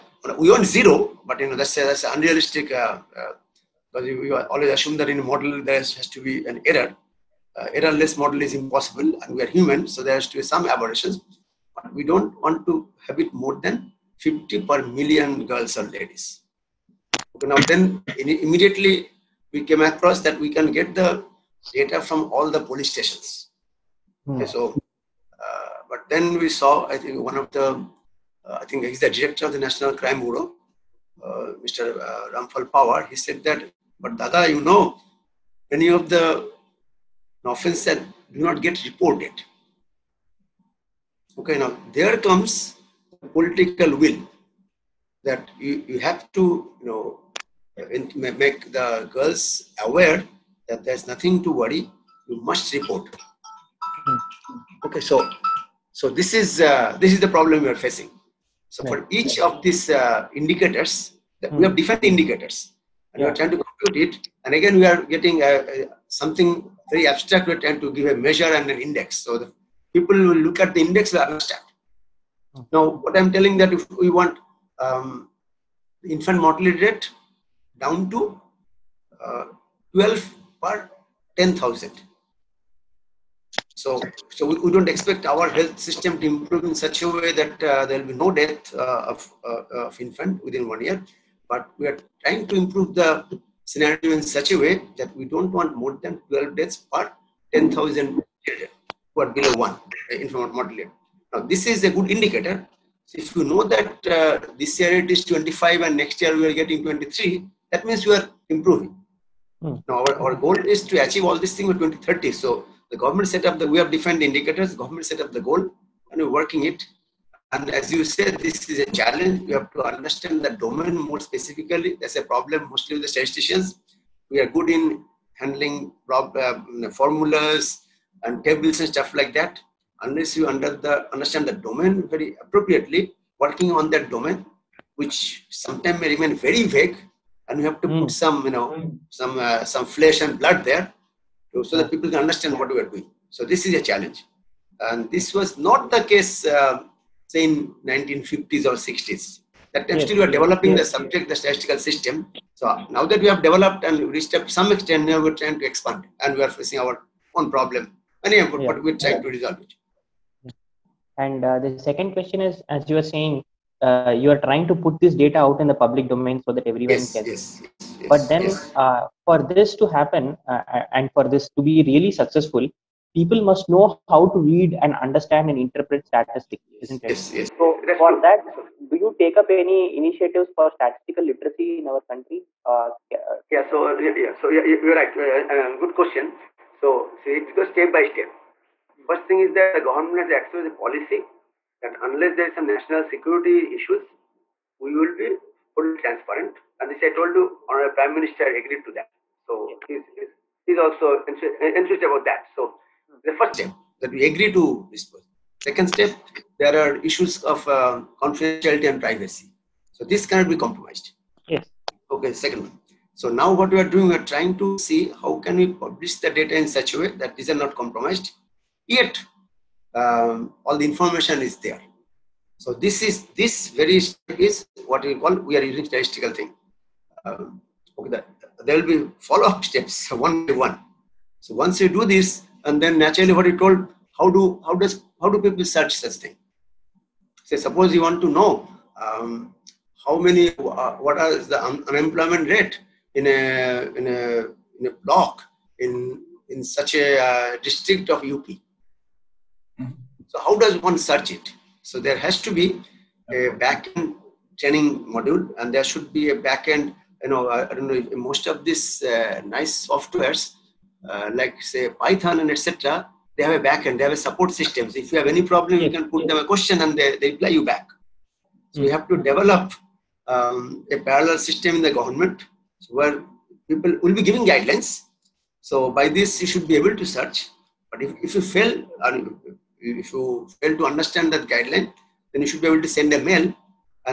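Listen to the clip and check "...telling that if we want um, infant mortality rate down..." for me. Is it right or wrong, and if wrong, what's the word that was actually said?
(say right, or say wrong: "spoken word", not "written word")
right.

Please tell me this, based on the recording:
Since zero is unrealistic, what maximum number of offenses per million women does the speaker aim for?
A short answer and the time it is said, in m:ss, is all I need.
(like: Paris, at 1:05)
50, at 0:14.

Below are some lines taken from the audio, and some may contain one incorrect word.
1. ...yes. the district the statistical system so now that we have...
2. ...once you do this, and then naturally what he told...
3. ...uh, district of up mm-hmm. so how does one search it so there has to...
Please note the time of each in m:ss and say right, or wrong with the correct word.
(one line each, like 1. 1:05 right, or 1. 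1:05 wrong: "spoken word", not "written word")
1. 2:30 wrong: "subject", not "district"
2. 3:51 right
3. 4:07 right.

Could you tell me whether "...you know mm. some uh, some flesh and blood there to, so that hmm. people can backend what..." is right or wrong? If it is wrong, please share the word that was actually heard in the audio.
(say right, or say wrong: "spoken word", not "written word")
wrong: "understand", not "backend".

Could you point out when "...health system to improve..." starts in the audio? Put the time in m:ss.
1:25.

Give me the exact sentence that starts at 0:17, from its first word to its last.
Okay, now then immediately we came across that we can get the data from all the police stations.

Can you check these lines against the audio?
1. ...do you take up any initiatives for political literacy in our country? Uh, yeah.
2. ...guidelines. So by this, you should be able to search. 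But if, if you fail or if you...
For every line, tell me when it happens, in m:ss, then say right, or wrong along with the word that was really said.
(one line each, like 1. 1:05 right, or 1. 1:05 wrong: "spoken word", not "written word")
1. 2:58 wrong: "statistical", not "political"
2. 4:34 right.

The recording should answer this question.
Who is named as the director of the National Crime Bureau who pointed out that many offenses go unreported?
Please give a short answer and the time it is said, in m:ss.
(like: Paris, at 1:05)
Ramphal Pawar, at 0:32.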